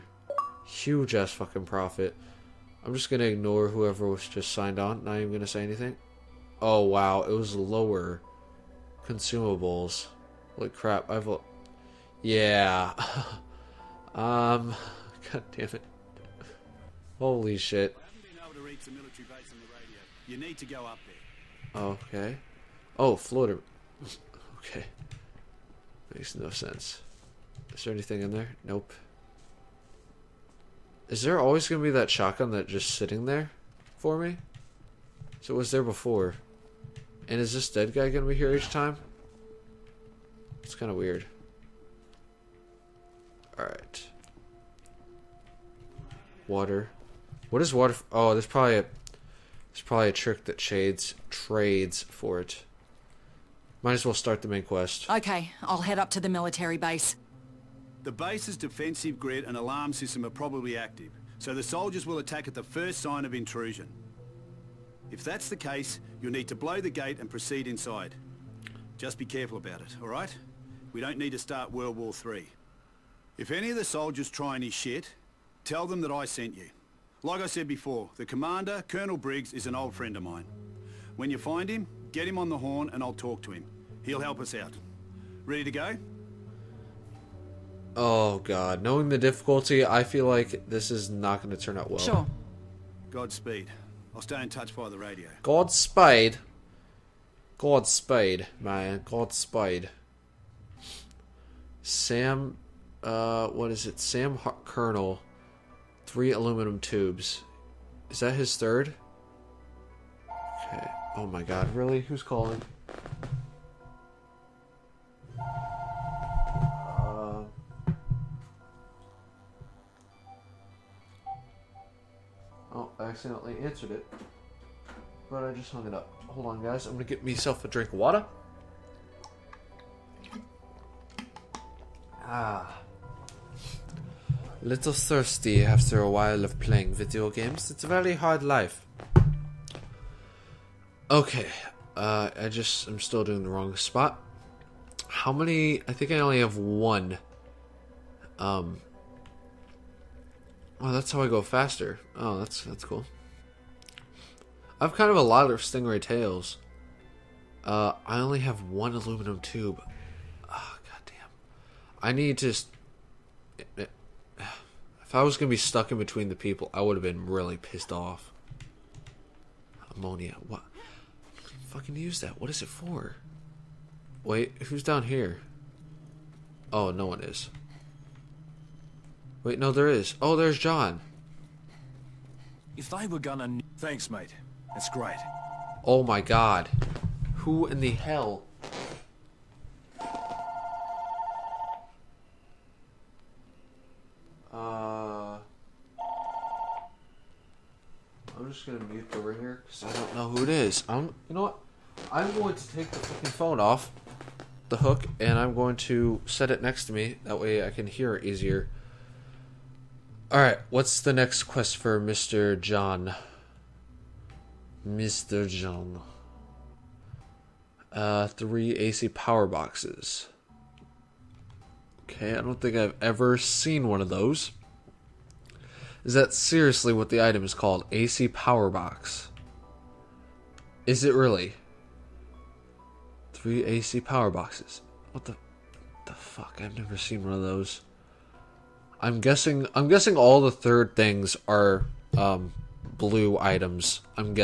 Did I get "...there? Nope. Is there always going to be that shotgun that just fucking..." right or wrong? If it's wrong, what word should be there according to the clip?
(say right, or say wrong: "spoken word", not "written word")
wrong: "sitting", not "fucking".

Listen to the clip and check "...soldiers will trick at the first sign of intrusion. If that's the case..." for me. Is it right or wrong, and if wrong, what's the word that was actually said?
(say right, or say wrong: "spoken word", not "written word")
wrong: "attack", not "trick".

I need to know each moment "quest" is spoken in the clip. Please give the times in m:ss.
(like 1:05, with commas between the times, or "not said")
0:54, 3:31.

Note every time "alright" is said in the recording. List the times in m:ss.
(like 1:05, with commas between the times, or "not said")
0:43, 1:10.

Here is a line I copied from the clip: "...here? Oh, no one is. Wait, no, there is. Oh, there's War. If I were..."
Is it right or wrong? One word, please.
wrong.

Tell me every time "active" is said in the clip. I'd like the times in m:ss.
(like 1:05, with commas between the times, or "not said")
1:00.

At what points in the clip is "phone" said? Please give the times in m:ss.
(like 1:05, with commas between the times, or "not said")
3:23.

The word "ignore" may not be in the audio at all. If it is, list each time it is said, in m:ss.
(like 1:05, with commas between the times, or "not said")
0:03.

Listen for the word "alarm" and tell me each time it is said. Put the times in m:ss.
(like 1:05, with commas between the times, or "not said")
0:59.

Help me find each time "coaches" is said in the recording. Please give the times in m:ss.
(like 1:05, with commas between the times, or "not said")
not said.